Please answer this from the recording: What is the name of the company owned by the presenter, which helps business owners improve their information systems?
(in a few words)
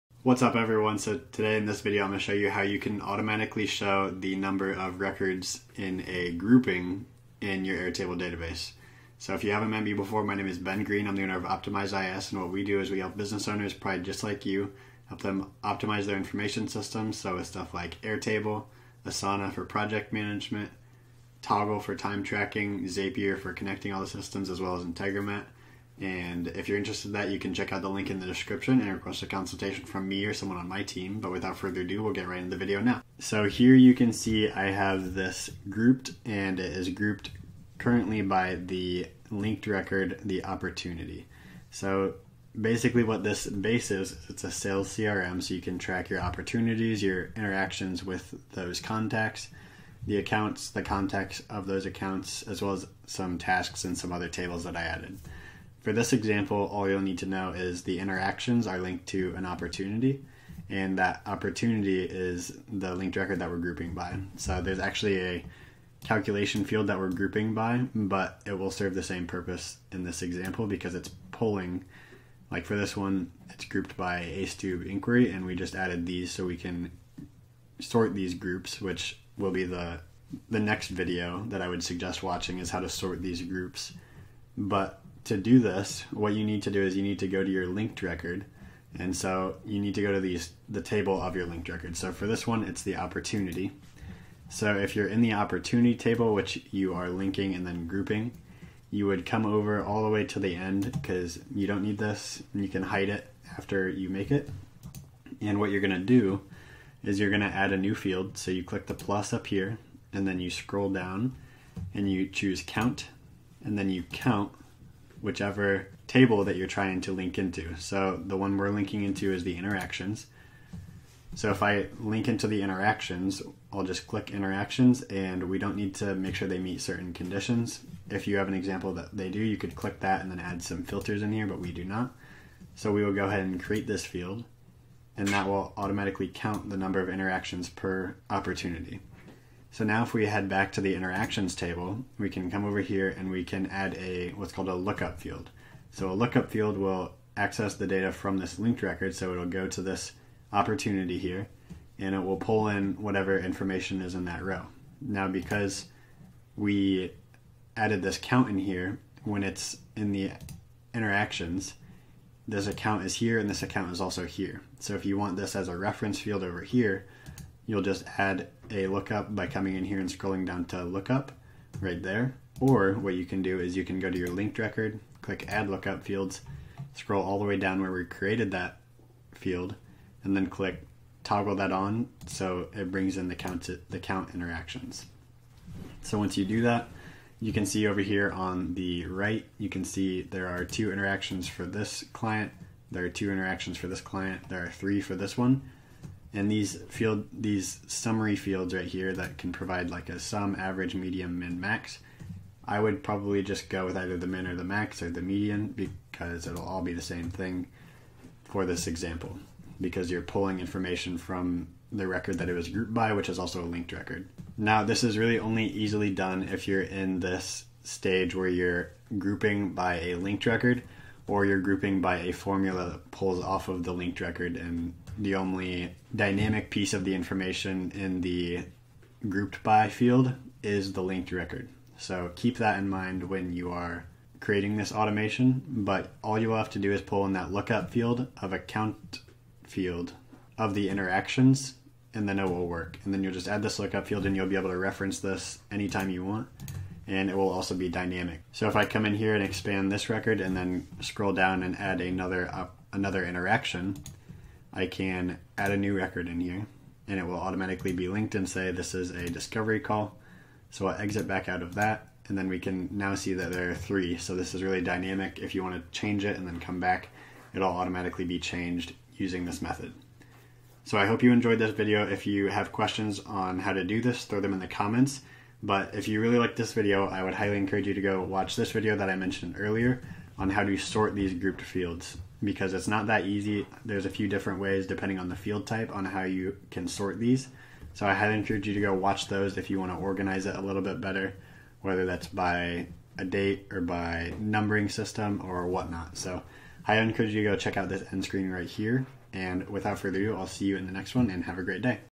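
Optimize IS.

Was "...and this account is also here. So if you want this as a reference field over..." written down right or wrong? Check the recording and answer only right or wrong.
right.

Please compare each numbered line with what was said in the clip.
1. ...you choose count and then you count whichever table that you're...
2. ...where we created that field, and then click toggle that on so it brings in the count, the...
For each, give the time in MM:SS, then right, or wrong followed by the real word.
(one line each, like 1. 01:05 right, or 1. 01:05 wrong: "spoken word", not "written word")
1. 01:52 right
2. 02:57 right.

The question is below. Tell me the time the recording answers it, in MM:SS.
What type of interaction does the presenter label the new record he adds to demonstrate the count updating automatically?
04:19.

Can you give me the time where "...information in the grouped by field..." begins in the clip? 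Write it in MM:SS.
03:47.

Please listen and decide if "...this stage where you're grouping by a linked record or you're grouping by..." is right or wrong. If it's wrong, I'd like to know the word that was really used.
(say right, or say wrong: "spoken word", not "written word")
right.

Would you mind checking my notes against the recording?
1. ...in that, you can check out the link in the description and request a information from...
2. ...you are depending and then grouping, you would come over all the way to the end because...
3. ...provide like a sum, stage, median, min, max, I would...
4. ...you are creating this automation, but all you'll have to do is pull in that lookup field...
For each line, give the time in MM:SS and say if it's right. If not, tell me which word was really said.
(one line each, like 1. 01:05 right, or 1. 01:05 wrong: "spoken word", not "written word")
1. 00:27 wrong: "consultation", not "information"
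2. 01:36 wrong: "linking", not "depending"
3. 03:19 wrong: "average", not "stage"
4. 03:53 right.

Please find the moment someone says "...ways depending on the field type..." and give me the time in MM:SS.
04:44.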